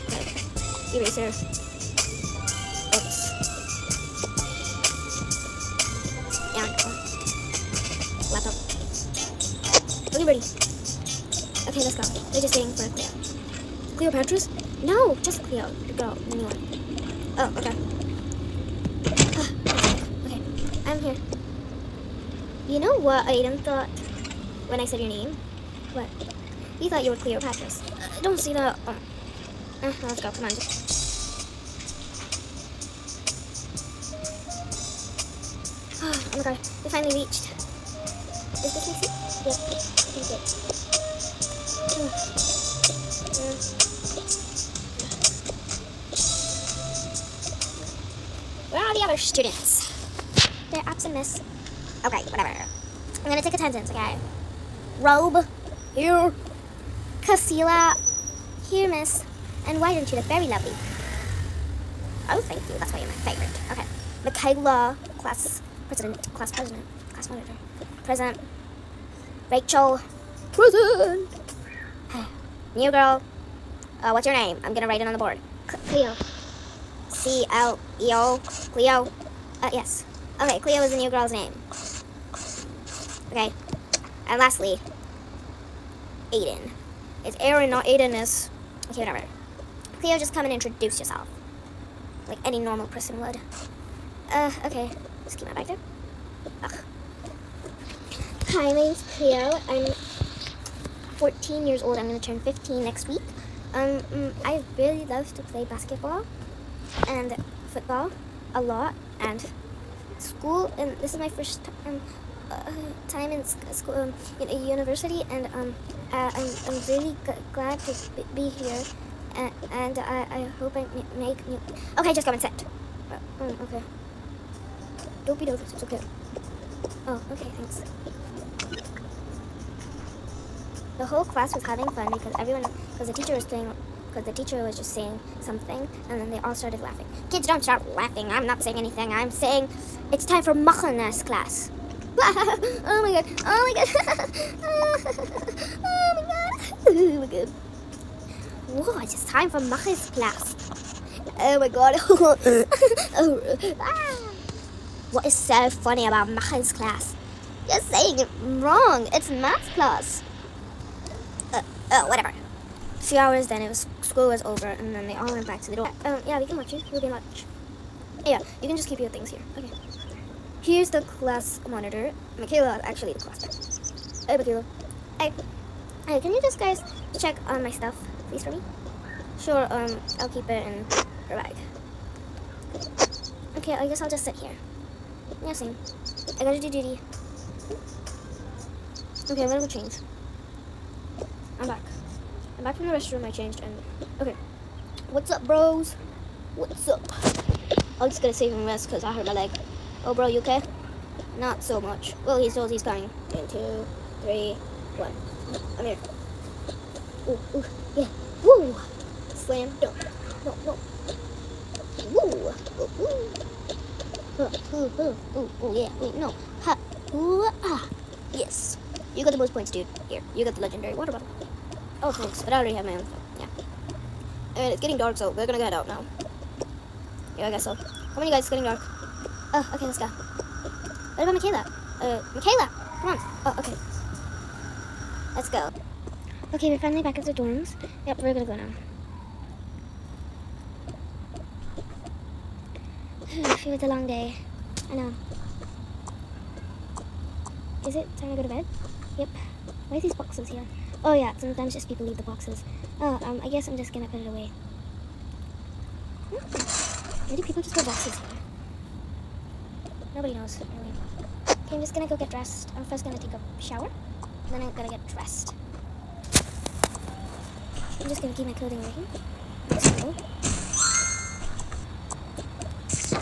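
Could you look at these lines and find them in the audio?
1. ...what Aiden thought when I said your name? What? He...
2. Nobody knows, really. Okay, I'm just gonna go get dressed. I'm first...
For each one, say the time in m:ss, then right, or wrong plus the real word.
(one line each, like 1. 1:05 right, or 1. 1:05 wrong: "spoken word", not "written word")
1. 0:22 right
2. 4:20 right.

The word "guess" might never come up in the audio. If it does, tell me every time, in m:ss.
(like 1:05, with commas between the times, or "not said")
3:03, 3:47, 4:13.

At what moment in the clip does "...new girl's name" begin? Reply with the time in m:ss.
1:20.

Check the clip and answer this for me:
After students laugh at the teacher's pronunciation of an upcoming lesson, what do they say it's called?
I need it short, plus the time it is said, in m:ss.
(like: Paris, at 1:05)
math class, at 2:39.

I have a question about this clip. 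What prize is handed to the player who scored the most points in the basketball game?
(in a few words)
legendary water bottle.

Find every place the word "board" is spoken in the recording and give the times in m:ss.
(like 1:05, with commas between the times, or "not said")
1:15.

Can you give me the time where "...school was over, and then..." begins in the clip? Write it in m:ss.
2:44.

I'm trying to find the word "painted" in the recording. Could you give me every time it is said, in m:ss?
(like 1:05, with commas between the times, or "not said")
not said.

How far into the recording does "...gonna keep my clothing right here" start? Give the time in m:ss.
4:28.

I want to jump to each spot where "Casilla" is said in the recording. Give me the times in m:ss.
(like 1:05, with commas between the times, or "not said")
0:57.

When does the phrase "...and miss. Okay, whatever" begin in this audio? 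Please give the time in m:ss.
0:51.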